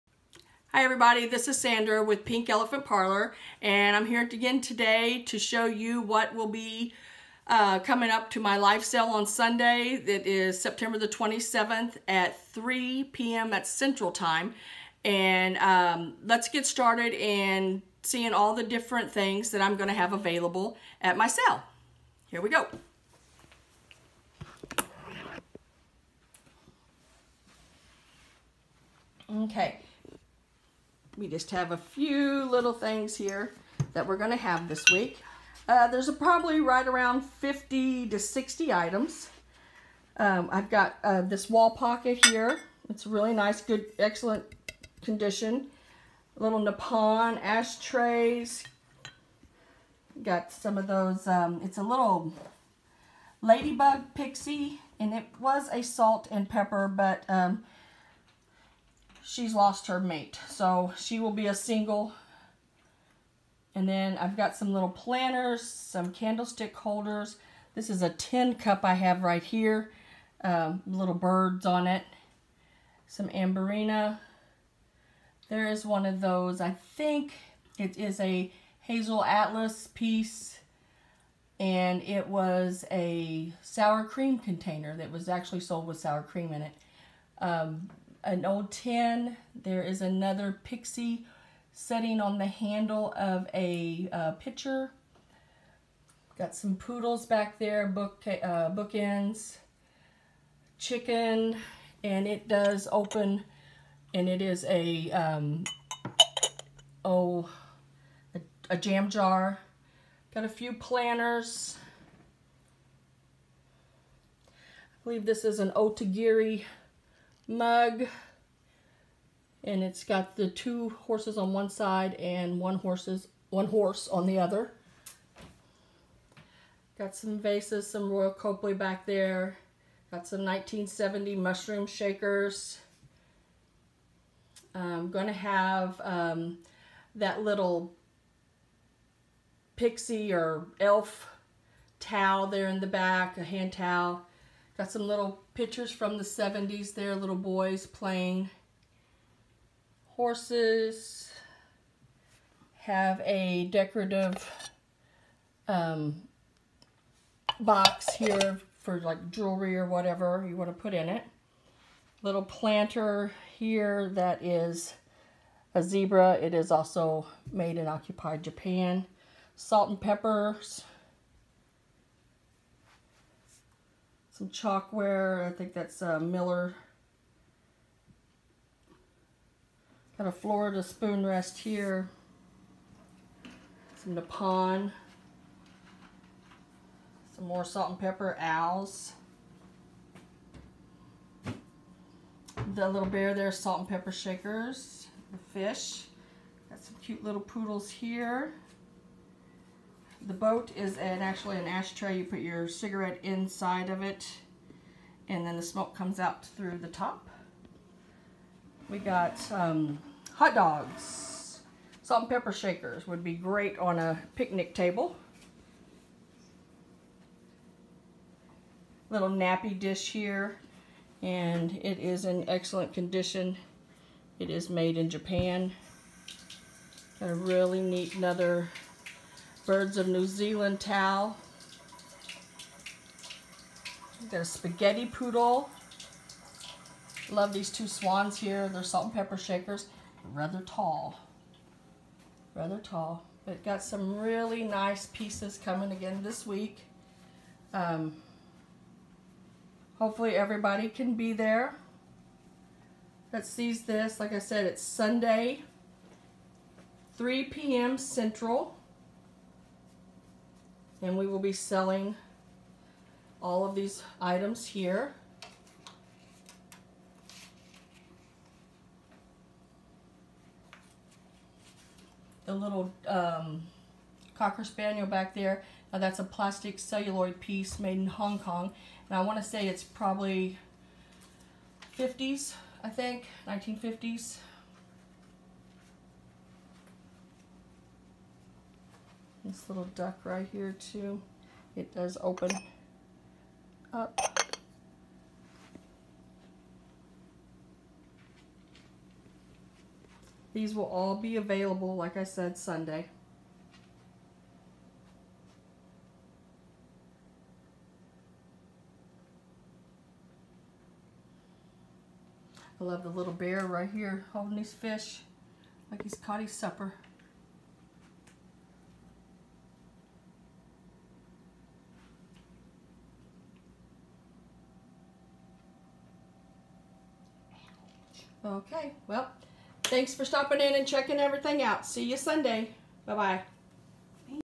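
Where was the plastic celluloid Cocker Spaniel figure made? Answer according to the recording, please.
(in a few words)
Hong Kong.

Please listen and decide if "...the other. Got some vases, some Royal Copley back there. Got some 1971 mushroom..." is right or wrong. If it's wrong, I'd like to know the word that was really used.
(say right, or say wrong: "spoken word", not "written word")
wrong: "1970", not "1971".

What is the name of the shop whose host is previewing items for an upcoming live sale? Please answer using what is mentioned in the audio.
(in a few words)
Pink Elephant Parlor.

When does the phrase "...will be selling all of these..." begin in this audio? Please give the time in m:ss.
4:21.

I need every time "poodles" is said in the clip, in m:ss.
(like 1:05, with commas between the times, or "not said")
1:36, 3:17, 3:55.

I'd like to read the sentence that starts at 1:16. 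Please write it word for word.
I think it is a hazel atlas piece.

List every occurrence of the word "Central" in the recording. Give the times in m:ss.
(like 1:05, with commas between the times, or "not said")
0:13, 4:17.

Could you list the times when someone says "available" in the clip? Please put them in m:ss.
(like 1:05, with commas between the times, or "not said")
0:20, 5:01.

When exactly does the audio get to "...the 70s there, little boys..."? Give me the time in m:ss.
2:26.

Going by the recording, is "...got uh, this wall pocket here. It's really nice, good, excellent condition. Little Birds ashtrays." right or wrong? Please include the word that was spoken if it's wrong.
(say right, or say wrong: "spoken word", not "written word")
wrong: "Nippon", not "Birds".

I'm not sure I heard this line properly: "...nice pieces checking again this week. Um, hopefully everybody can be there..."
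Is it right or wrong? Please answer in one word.
wrong.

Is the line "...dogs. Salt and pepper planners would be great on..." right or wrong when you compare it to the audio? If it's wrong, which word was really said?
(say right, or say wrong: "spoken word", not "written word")
wrong: "shakers", not "planners".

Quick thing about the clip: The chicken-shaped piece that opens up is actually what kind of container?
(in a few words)
jam jar.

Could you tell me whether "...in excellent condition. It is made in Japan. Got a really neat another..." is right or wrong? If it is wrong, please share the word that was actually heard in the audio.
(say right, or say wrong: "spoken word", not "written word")
right.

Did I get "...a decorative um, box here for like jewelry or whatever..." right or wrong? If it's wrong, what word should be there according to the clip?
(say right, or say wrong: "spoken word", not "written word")
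right.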